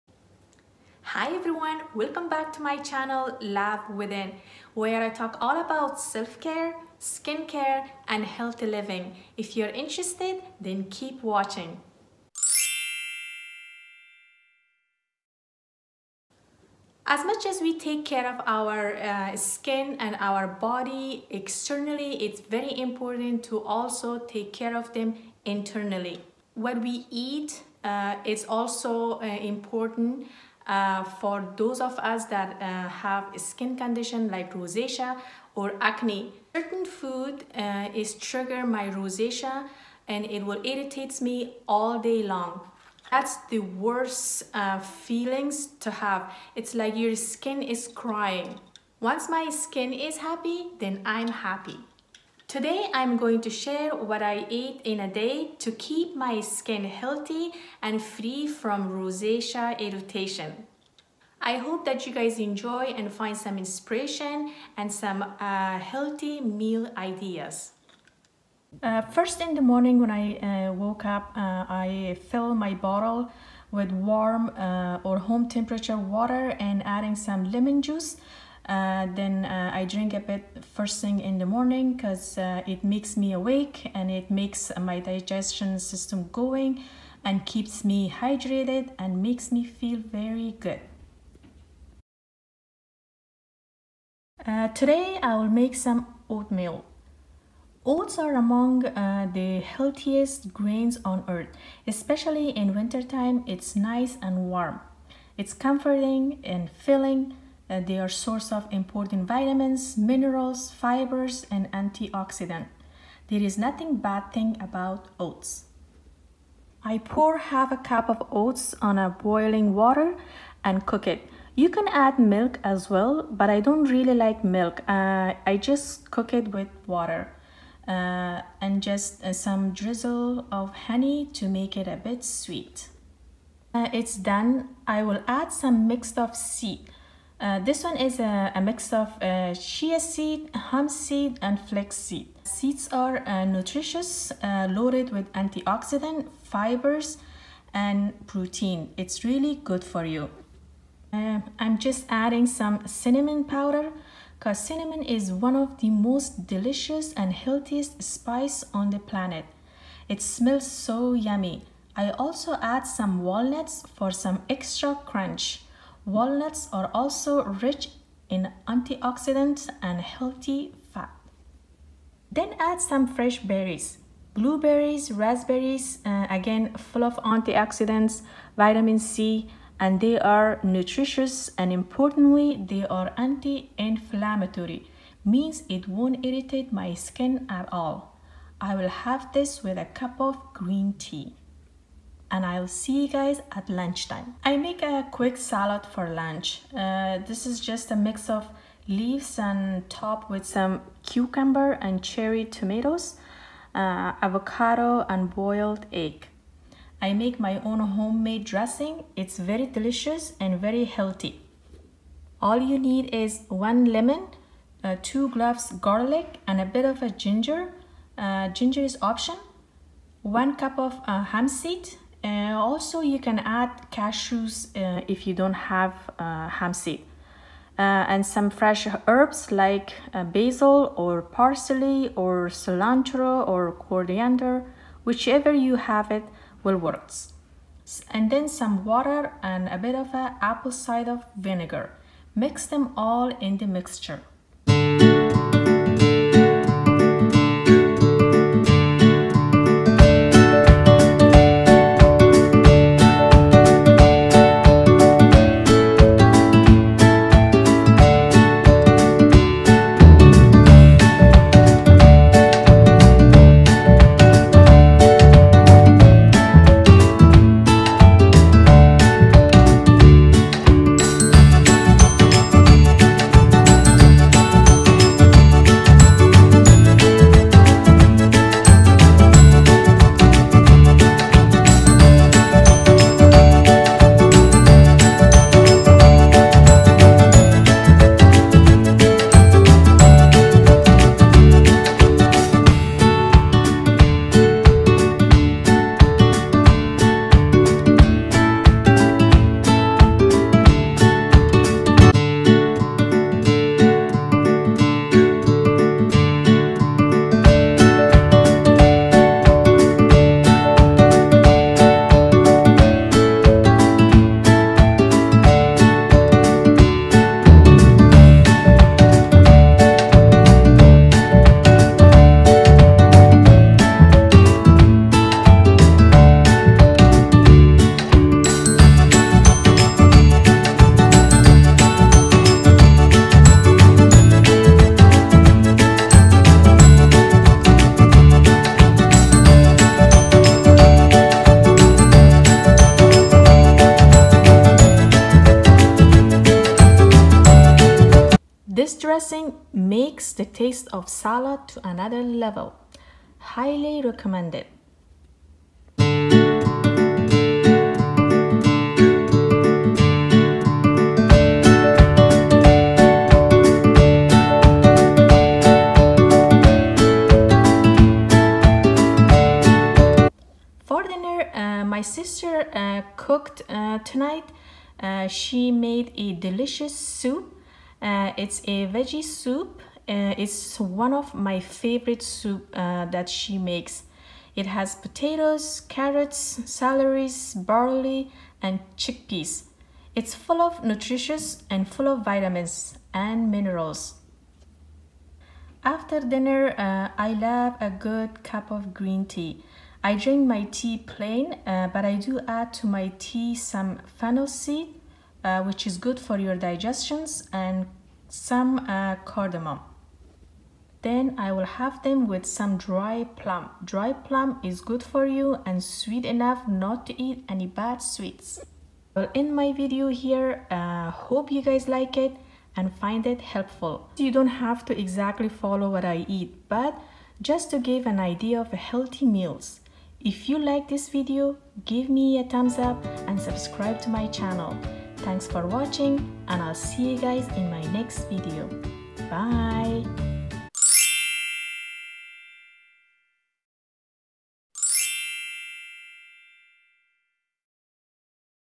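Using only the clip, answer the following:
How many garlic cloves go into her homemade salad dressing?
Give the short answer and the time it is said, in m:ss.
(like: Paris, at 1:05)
2, at 3:35.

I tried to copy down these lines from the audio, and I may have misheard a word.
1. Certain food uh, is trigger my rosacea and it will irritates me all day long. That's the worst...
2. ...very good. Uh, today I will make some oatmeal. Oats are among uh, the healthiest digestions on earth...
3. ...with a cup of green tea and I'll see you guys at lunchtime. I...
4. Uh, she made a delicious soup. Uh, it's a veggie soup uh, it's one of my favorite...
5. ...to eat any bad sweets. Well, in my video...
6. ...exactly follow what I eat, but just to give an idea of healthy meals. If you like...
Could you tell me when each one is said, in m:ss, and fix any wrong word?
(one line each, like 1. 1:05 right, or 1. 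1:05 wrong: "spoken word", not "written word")
1. 0:36 right
2. 1:29 wrong: "grains", not "digestions"
3. 3:09 right
4. 6:15 right
5. 6:57 right
6. 7:04 right.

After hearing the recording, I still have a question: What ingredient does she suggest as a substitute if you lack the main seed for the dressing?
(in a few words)
Cashews.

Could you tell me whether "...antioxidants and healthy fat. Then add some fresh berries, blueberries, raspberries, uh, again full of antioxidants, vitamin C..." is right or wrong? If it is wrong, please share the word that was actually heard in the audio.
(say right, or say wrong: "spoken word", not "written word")
right.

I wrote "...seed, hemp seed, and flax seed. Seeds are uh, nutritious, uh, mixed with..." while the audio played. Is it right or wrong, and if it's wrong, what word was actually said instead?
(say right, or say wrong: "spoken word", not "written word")
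wrong: "loaded", not "mixed".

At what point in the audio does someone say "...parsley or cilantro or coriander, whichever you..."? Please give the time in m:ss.
3:51.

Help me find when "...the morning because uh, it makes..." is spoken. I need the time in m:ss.
1:21.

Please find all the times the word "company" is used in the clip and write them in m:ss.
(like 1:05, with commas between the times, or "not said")
not said.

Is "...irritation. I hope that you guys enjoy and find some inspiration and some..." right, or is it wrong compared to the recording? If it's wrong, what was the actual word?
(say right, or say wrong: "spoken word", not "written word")
right.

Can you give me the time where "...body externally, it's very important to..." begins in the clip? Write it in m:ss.
0:20.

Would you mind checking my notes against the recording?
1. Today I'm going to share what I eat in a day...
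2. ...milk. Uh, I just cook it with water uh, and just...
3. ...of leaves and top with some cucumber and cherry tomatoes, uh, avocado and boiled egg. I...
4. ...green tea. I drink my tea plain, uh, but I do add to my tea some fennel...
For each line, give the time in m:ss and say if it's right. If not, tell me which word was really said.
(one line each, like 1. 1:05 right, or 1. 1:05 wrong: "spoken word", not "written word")
1. 0:52 right
2. 2:04 right
3. 3:18 right
4. 6:38 right.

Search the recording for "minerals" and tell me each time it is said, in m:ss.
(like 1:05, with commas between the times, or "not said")
1:49, 6:33.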